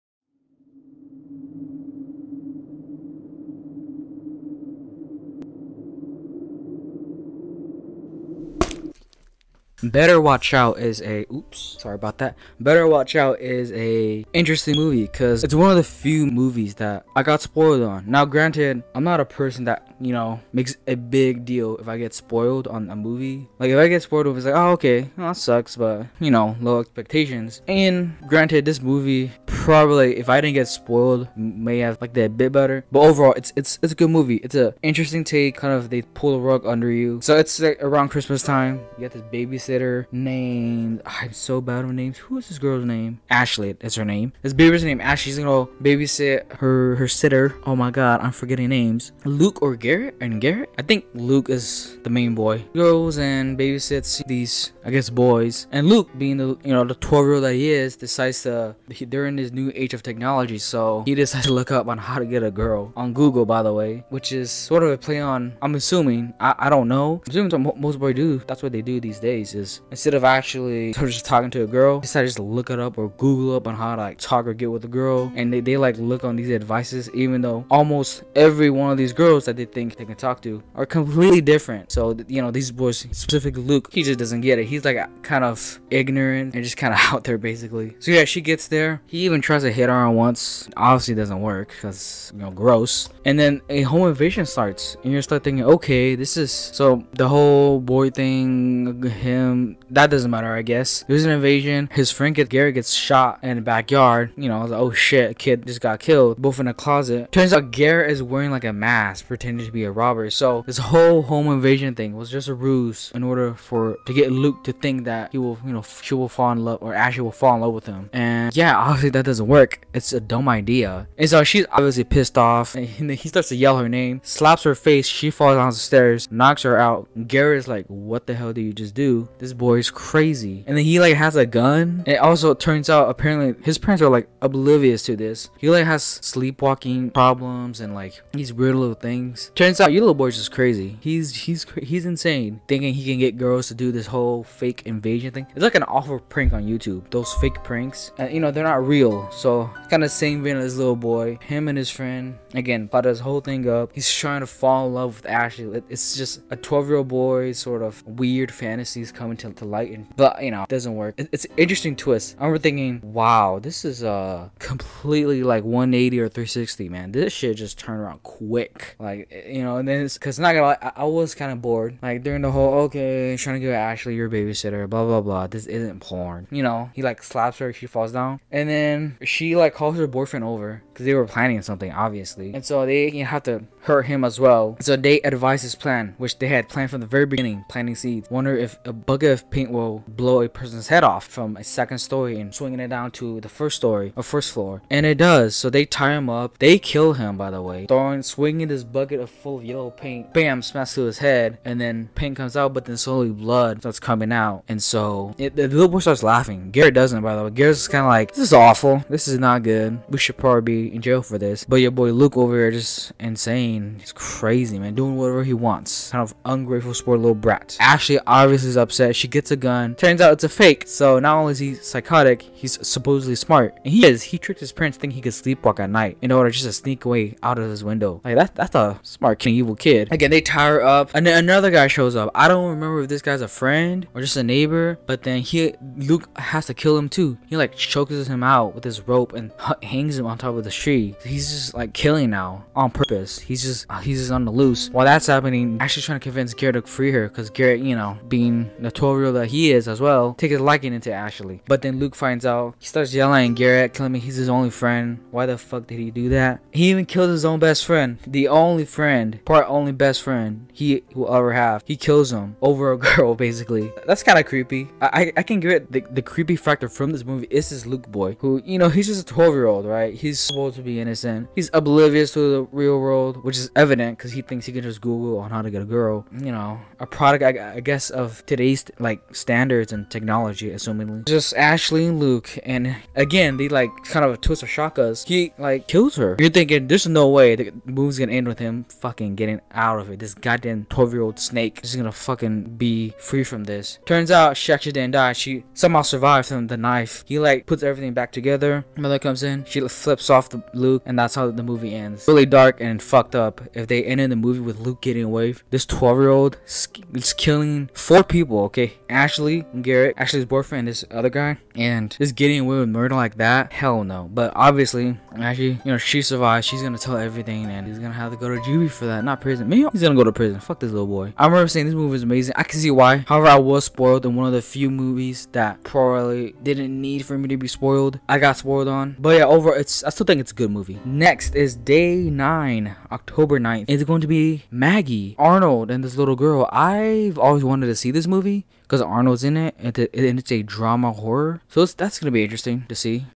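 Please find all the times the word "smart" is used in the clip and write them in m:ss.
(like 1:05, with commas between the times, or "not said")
3:43, 3:49.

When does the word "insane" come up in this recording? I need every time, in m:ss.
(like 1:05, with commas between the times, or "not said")
2:22, 3:33.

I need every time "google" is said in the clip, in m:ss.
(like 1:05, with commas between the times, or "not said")
1:03, 1:13, 4:35.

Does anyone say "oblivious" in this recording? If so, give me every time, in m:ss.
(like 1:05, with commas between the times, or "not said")
2:14, 4:31.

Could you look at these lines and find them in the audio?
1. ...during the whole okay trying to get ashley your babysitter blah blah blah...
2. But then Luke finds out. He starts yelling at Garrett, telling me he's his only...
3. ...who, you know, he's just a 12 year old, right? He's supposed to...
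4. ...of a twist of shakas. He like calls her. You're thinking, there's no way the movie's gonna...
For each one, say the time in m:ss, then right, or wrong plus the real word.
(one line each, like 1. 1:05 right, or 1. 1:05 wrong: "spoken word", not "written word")
1. 2:52 right
2. 4:11 right
3. 4:28 right
4. 4:44 wrong: "kills", not "calls".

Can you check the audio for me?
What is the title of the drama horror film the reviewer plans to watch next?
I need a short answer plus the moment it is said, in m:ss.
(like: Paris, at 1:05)
Maggie, at 5:34.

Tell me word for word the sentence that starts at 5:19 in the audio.
Me, he's gonna go to prison.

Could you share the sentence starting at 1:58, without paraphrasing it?
And yeah, obviously that doesn't work.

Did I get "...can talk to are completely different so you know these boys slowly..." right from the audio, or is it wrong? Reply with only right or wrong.
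wrong.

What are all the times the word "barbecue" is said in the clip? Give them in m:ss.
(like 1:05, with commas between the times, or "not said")
not said.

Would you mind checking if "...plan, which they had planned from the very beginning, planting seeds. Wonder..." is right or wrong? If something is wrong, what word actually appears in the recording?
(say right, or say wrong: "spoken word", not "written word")
right.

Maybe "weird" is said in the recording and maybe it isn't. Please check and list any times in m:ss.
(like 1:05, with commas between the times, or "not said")
2:18, 2:38.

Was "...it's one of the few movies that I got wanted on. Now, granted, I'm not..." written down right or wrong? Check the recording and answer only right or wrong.
wrong.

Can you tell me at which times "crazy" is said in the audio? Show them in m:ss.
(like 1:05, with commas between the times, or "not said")
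2:09, 2:20, 3:34.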